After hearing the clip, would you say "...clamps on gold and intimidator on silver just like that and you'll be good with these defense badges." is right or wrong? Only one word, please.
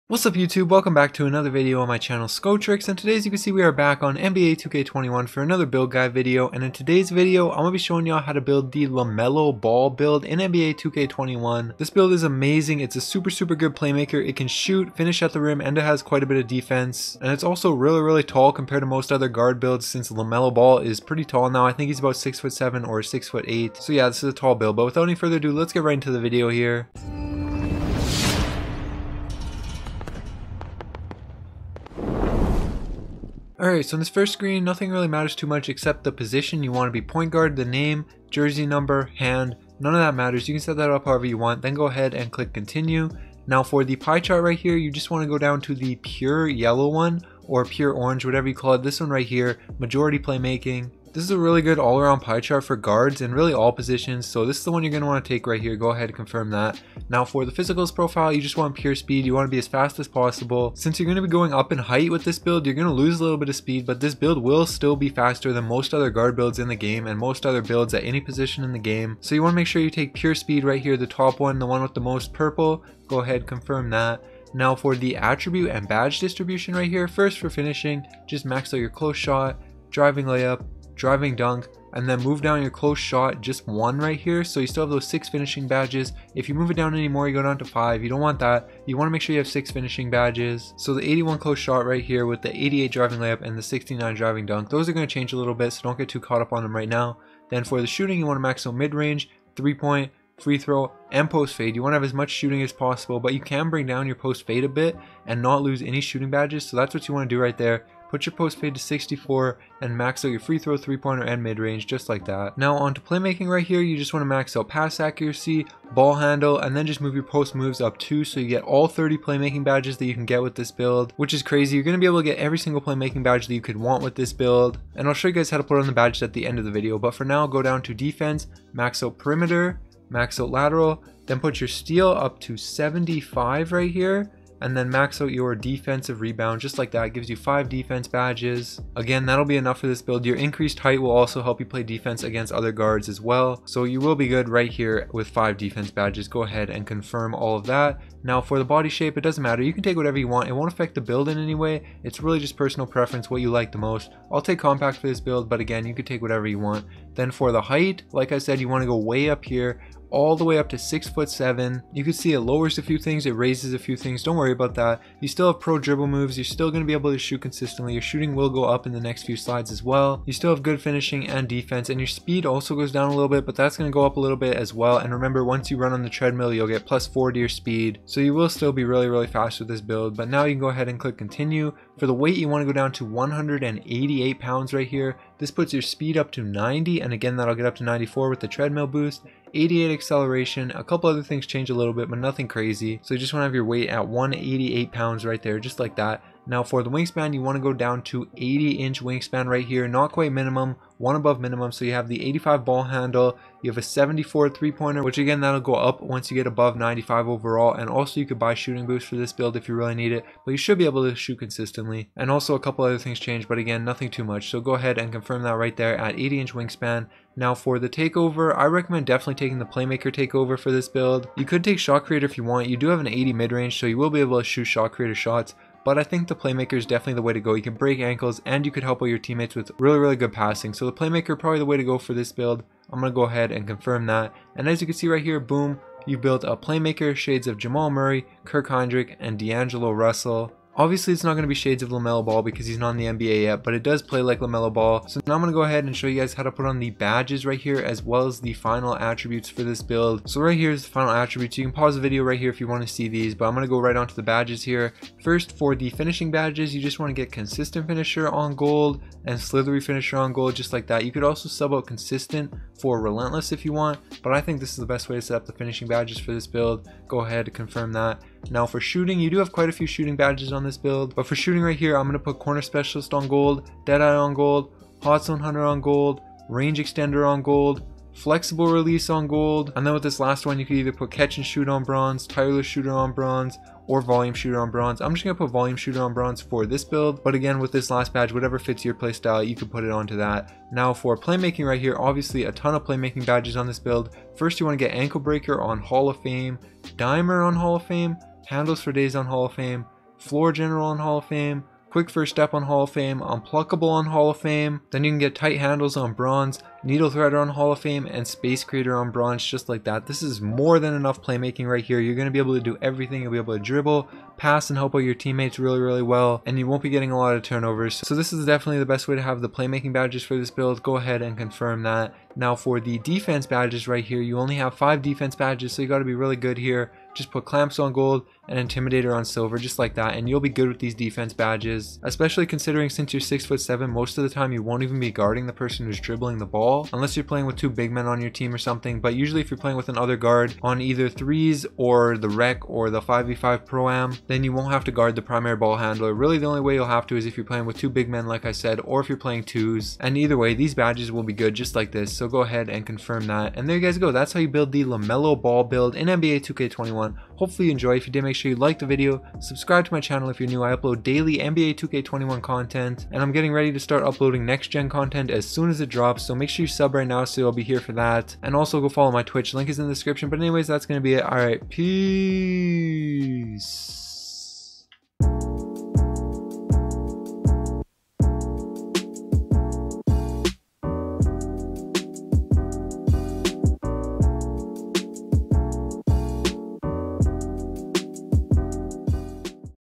right.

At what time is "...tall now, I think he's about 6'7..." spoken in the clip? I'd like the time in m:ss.
0:21.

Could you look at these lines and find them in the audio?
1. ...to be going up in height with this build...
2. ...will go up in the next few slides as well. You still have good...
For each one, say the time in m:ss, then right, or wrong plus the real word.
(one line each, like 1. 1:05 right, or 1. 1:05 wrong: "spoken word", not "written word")
1. 1:01 right
2. 2:48 right.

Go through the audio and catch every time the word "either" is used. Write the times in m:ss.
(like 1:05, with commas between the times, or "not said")
4:40, 5:40, 5:50.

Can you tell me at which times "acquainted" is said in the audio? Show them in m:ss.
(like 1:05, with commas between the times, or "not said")
not said.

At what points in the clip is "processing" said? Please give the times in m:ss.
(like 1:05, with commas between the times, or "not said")
not said.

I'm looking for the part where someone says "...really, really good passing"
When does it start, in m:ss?
3:49.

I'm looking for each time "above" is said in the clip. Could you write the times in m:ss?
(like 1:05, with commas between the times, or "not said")
3:21, 3:26.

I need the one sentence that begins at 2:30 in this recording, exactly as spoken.
It won't affect the build in any way.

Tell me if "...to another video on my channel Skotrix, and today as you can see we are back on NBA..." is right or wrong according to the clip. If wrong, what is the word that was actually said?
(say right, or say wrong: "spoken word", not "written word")
right.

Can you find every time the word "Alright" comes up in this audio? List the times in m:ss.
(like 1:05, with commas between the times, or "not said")
0:33, 6:11.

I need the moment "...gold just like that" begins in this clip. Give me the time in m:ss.
4:20.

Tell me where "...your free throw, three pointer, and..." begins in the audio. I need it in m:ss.
1:50.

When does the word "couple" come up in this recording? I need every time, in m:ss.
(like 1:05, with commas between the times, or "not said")
3:10, 3:32.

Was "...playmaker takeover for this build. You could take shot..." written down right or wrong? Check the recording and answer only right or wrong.
right.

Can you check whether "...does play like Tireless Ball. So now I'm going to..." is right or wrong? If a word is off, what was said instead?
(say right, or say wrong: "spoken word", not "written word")
wrong: "LaMelo", not "Tireless".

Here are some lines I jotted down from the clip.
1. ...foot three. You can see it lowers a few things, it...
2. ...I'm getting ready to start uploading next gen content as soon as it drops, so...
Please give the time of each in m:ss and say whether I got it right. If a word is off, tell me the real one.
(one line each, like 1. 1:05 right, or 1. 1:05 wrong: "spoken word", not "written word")
1. 2:41 wrong: "seven", not "three"
2. 6:03 right.